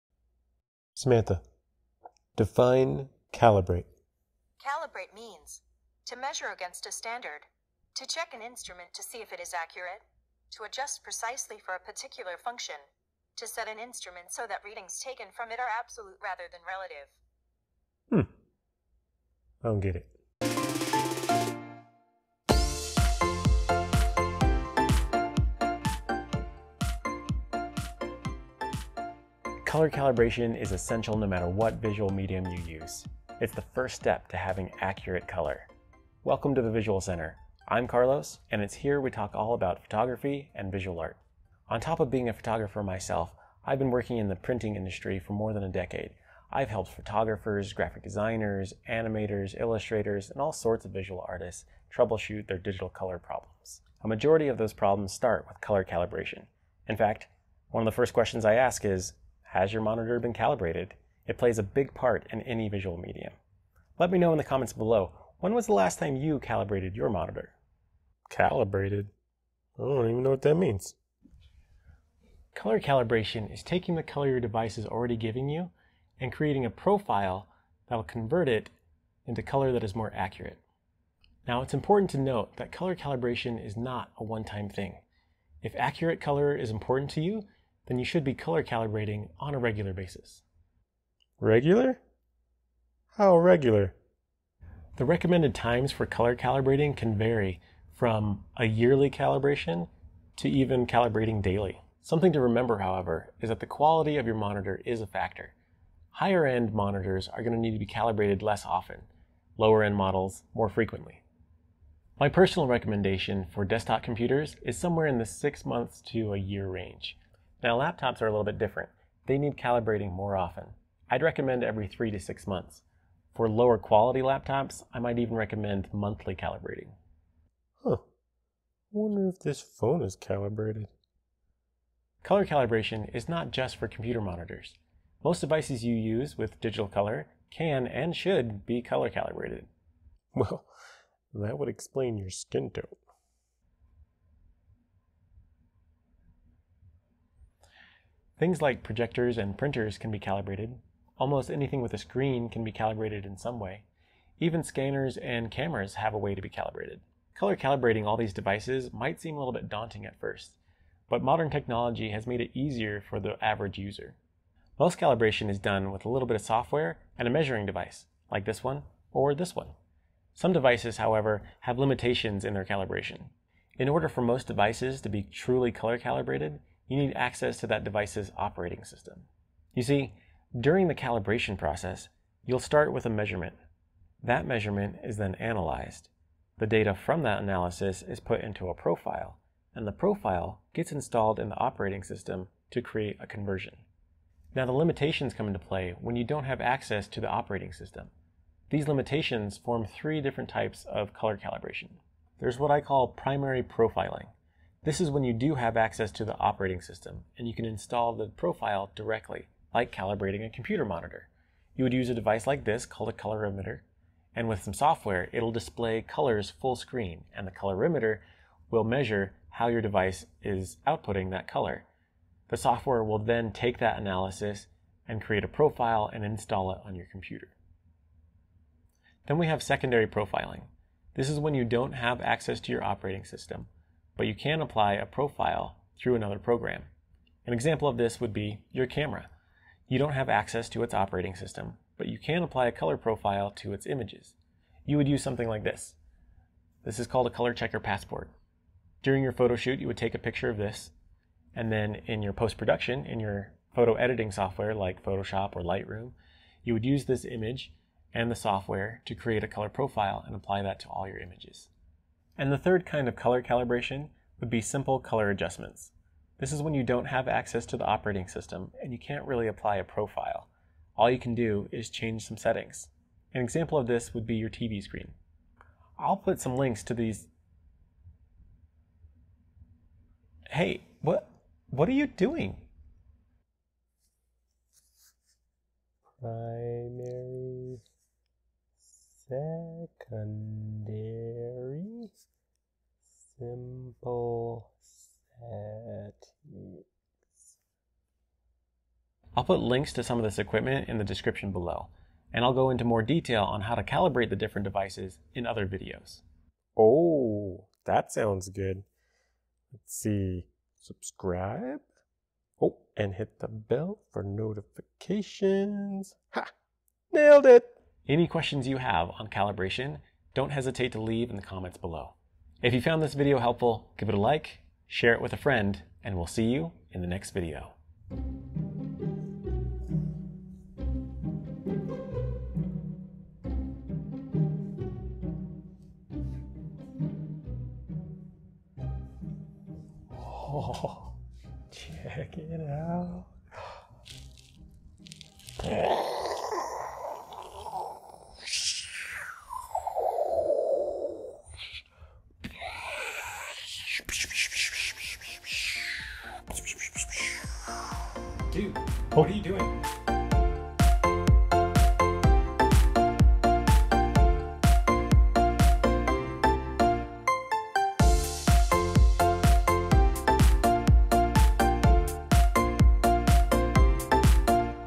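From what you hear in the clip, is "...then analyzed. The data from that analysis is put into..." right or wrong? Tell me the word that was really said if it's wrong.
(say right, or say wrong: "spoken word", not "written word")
right.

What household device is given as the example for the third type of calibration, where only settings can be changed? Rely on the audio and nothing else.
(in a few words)
TV screen.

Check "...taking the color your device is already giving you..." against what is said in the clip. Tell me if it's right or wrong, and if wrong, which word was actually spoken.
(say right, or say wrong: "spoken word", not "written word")
right.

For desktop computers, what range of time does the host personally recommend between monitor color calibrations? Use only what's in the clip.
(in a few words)
6 months to a year.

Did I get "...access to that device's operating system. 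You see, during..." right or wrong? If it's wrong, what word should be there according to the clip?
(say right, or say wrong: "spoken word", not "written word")
right.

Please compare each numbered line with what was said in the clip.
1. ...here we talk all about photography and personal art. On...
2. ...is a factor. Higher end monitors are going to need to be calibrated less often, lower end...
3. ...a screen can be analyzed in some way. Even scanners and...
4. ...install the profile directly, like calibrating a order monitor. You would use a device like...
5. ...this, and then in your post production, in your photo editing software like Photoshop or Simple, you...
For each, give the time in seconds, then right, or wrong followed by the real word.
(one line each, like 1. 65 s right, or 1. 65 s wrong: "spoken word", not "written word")
1. 38 s wrong: "visual", not "personal"
2. 104 s right
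3. 151 s wrong: "calibrated", not "analyzed"
4. 207 s wrong: "computer", not "order"
5. 250 s wrong: "Lightroom", not "Simple".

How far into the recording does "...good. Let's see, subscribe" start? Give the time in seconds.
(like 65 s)
308 s.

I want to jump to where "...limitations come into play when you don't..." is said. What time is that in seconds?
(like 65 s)
194 s.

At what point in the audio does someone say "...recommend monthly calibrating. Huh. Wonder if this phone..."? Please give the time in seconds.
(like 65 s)
125 s.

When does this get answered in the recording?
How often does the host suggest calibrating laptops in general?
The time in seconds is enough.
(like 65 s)
121 s.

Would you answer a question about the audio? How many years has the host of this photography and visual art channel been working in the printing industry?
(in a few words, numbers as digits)
More than a decade.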